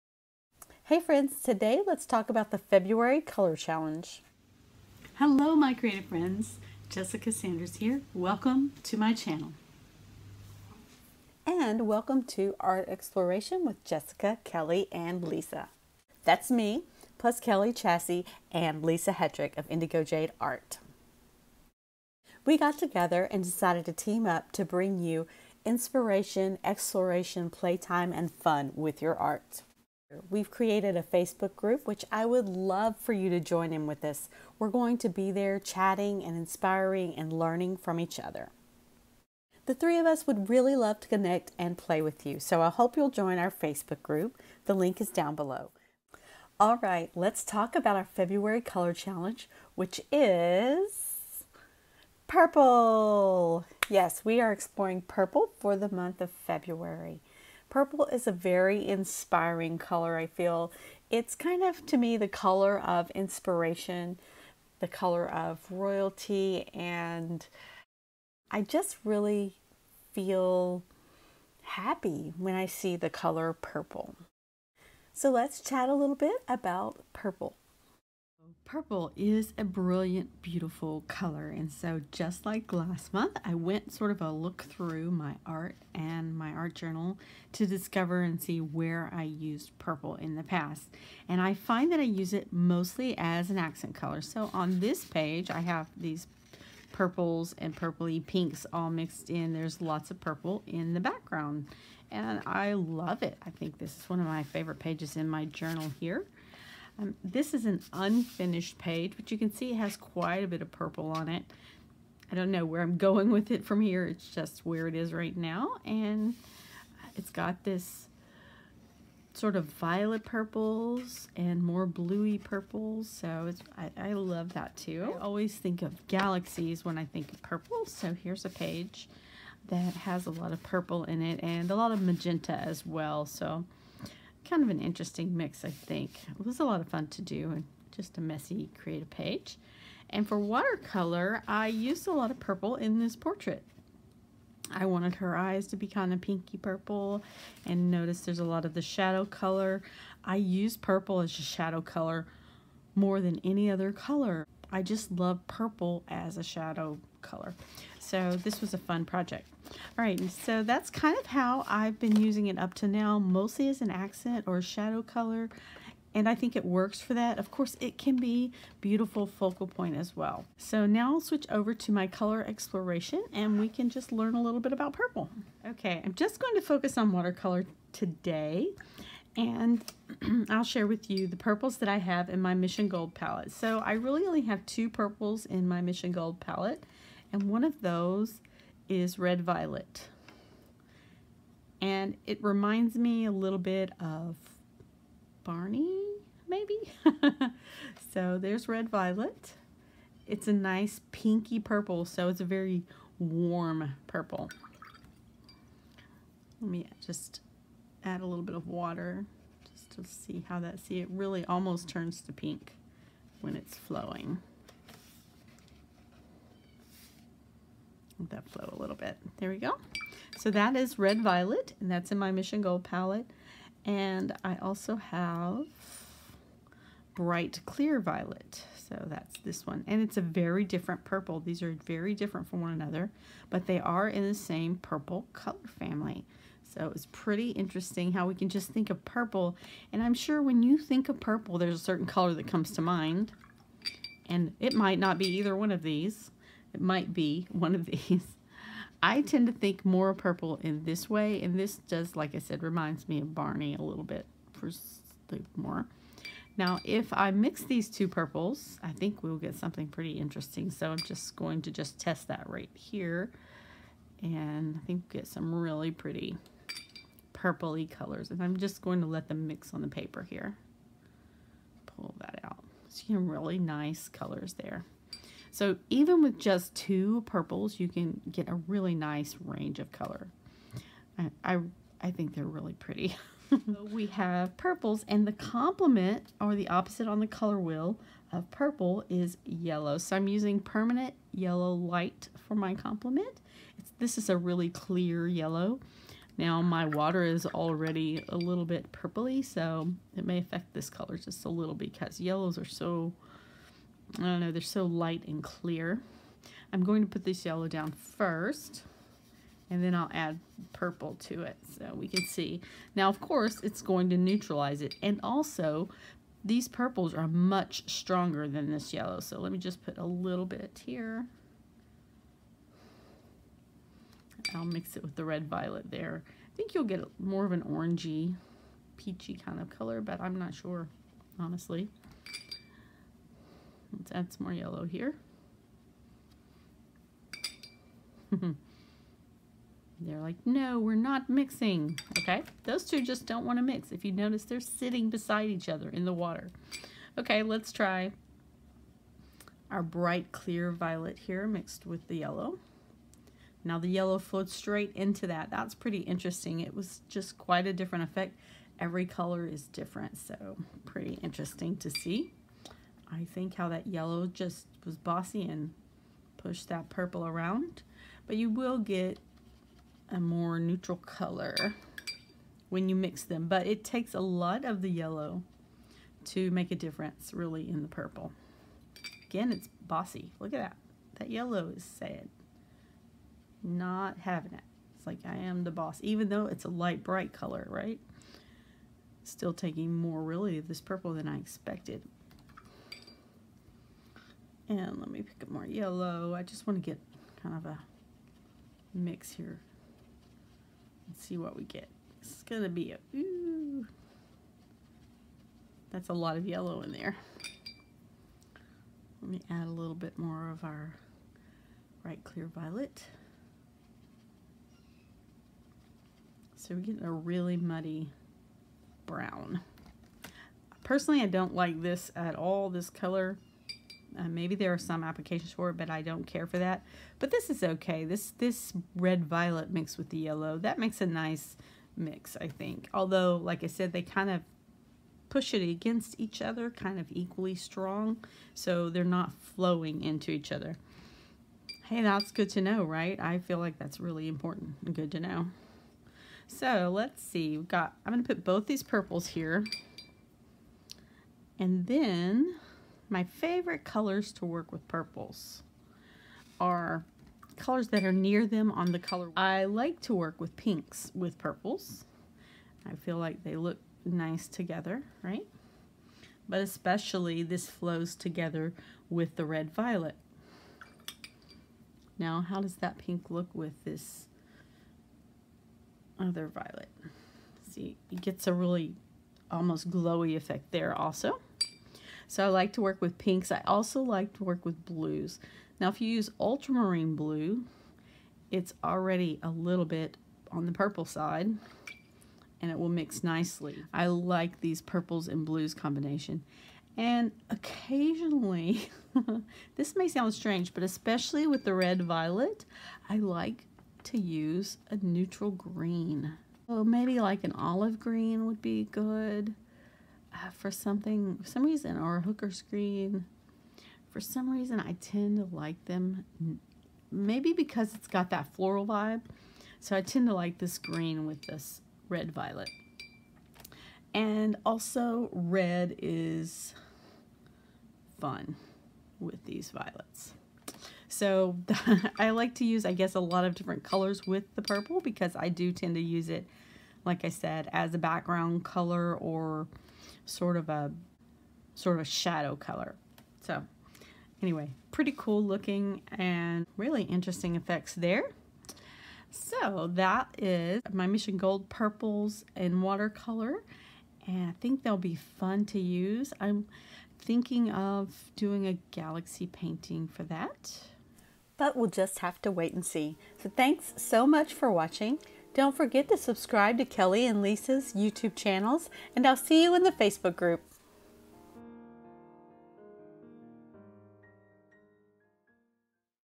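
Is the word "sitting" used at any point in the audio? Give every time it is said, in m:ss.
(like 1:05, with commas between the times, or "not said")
5:44.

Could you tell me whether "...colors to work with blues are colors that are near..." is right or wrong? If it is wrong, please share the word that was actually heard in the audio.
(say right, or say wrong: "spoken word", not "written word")
wrong: "purples", not "blues".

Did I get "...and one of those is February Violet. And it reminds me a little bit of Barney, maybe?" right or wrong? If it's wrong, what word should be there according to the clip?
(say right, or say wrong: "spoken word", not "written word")
wrong: "Red", not "February".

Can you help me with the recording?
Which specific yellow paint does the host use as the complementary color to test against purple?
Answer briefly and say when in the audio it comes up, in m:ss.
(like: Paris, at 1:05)
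Permanent yellow light, at 4:50.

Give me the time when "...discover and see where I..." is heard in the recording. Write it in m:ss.
1:27.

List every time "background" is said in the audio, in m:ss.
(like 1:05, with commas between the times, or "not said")
1:41, 8:57.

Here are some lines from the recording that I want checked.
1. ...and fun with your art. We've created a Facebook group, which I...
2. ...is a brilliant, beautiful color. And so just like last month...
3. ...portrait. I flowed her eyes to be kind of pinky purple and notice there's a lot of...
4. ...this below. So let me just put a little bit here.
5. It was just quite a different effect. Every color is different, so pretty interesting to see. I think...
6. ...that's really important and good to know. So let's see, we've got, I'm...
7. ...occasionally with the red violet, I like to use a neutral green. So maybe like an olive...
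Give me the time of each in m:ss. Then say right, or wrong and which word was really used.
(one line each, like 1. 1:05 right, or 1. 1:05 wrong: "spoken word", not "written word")
1. 0:28 right
2. 1:19 right
3. 2:23 wrong: "wanted", not "flowed"
4. 5:18 wrong: "yellow", not "below"
5. 5:56 right
6. 7:23 right
7. 8:20 wrong: "especially", not "occasionally".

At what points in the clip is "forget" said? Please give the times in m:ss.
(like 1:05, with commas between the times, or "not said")
9:25.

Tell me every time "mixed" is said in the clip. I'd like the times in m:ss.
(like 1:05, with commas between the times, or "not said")
1:38, 5:51, 7:09.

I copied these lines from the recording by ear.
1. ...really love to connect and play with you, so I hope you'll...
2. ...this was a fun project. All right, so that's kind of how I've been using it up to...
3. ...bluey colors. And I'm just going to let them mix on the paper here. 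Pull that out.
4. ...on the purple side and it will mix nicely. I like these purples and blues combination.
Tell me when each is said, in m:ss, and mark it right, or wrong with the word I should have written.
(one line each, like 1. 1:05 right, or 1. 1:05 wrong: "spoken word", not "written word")
1. 0:40 right
2. 2:38 right
3. 4:27 wrong: "purpley", not "bluey"
4. 8:10 right.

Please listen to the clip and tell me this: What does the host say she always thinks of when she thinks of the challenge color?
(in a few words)
Galaxies.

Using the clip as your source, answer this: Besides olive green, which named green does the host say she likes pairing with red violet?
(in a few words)
Hooker's green.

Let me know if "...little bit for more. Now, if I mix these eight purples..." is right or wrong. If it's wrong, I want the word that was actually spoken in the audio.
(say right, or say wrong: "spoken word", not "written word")
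wrong: "two", not "eight".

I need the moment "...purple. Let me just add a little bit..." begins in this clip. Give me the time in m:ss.
3:24.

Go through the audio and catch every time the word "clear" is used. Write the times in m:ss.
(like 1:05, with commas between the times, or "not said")
3:47, 4:54, 5:05, 5:50, 6:52.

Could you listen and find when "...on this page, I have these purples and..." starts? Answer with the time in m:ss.
1:34.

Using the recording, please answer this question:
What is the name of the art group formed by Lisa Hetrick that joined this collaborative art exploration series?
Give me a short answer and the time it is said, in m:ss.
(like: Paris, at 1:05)
Indigo Jade Art, at 0:19.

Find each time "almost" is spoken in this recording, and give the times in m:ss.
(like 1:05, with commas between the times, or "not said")
3:31, 7:59.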